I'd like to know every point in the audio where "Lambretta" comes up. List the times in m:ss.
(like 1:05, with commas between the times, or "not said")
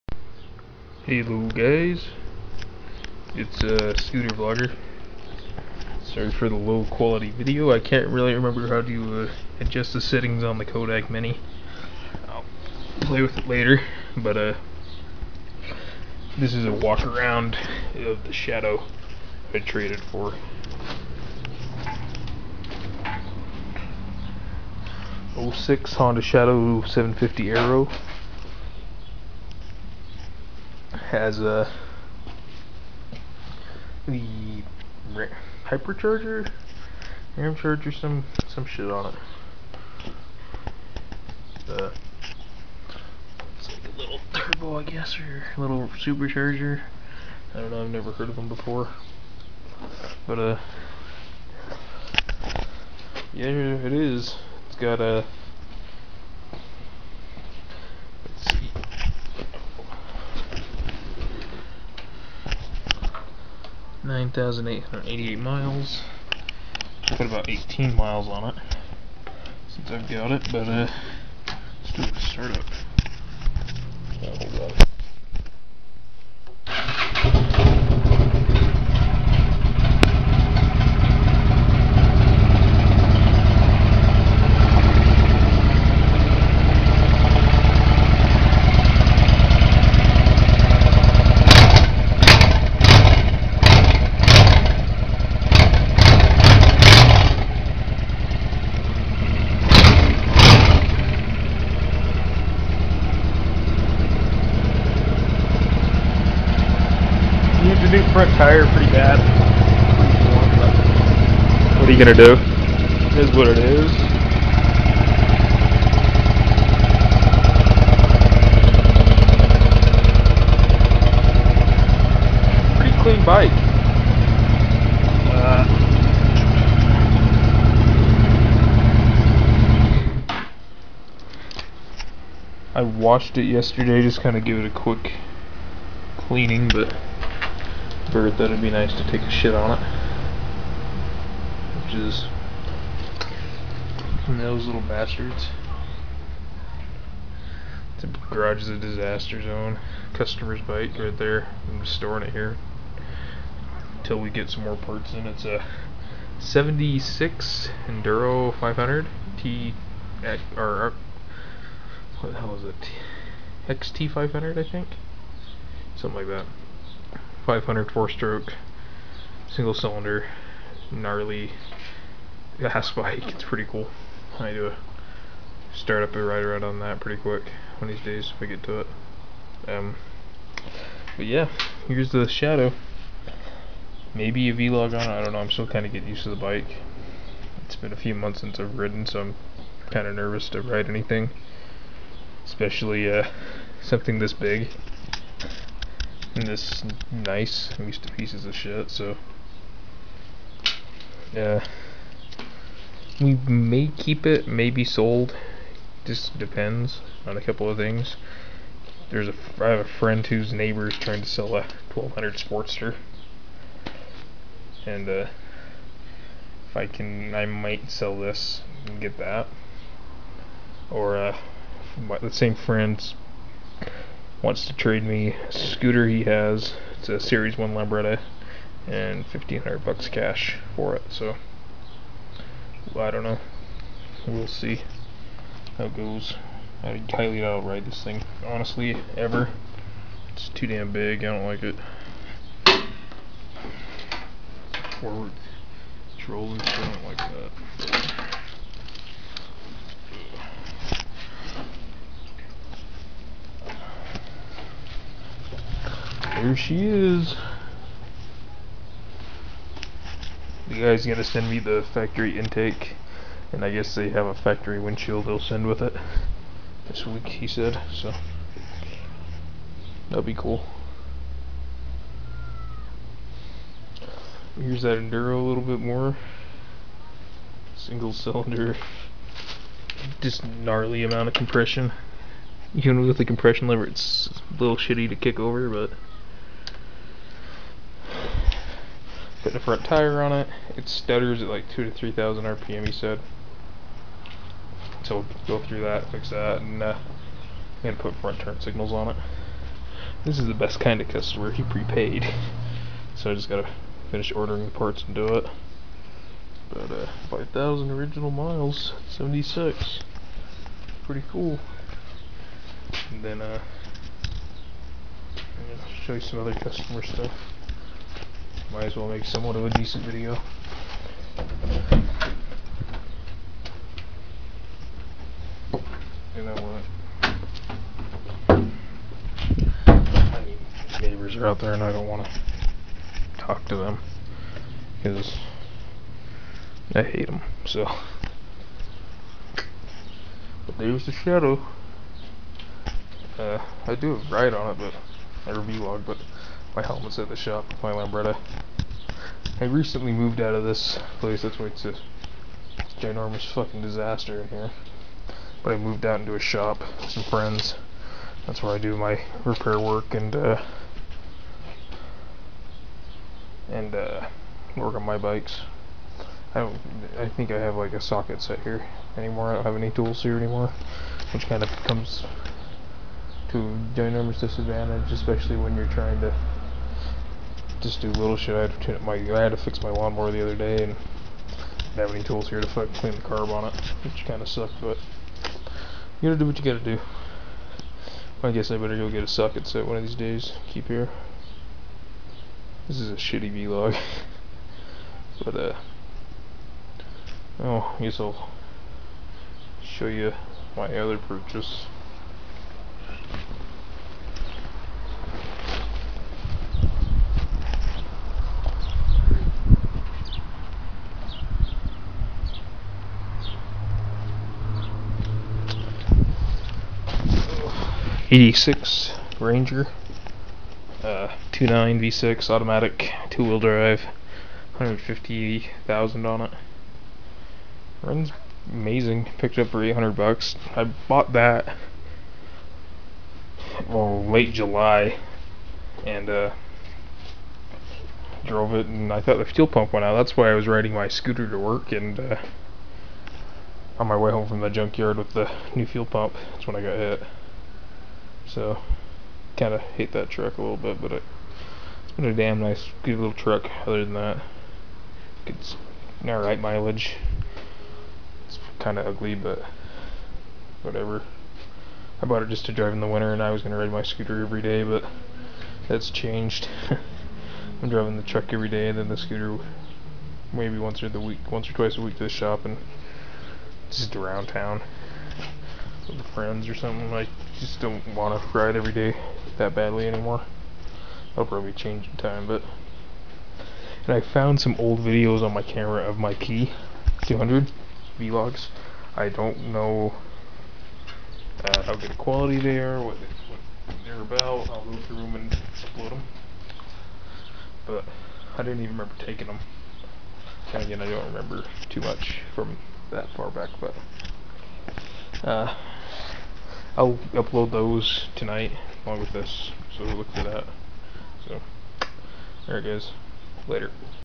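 3:47, 5:47.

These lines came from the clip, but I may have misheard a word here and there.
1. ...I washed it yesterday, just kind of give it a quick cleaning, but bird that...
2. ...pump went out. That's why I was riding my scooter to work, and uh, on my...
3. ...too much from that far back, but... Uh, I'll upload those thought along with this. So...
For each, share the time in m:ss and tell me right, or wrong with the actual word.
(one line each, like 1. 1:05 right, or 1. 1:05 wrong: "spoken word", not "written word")
1. 2:12 right
2. 7:19 right
3. 8:21 wrong: "tonight", not "thought".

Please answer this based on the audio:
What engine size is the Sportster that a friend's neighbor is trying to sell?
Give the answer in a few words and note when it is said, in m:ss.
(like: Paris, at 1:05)
1200, at 3:31.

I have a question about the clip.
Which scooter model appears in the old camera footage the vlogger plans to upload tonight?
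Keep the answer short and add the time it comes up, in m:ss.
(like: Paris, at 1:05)
P200, at 8:06.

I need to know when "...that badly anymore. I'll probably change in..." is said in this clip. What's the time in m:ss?
7:59.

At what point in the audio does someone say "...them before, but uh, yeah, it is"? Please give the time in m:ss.
0:48.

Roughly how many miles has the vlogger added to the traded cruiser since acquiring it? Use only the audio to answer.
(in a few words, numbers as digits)
18 miles.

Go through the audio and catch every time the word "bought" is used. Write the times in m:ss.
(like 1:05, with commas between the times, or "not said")
7:11, 7:42.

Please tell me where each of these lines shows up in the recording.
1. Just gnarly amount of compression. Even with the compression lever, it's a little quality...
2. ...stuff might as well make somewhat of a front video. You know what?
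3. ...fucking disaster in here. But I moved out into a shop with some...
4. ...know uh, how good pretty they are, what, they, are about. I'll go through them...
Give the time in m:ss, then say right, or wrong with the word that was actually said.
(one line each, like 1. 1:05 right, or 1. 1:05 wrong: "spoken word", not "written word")
1. 4:40 wrong: "shitty", not "quality"
2. 5:17 wrong: "decent", not "front"
3. 5:53 right
4. 8:09 wrong: "quality", not "pretty".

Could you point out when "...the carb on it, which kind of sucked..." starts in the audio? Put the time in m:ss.
6:23.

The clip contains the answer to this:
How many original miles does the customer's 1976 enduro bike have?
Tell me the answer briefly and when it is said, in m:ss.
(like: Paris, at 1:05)
5,000, at 5:07.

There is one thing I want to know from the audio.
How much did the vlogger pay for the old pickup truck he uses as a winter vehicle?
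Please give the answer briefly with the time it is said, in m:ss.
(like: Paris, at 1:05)
800 bucks, at 7:09.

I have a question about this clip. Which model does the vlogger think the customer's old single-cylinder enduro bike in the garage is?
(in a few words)
XT500.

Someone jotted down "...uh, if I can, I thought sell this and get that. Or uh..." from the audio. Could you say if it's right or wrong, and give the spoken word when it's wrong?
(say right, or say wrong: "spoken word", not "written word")
wrong: "might", not "thought".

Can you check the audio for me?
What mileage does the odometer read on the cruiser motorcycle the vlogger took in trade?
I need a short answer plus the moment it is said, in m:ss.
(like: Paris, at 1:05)
9,888 miles, at 1:04.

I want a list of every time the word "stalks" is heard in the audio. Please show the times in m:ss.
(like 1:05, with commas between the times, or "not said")
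not said.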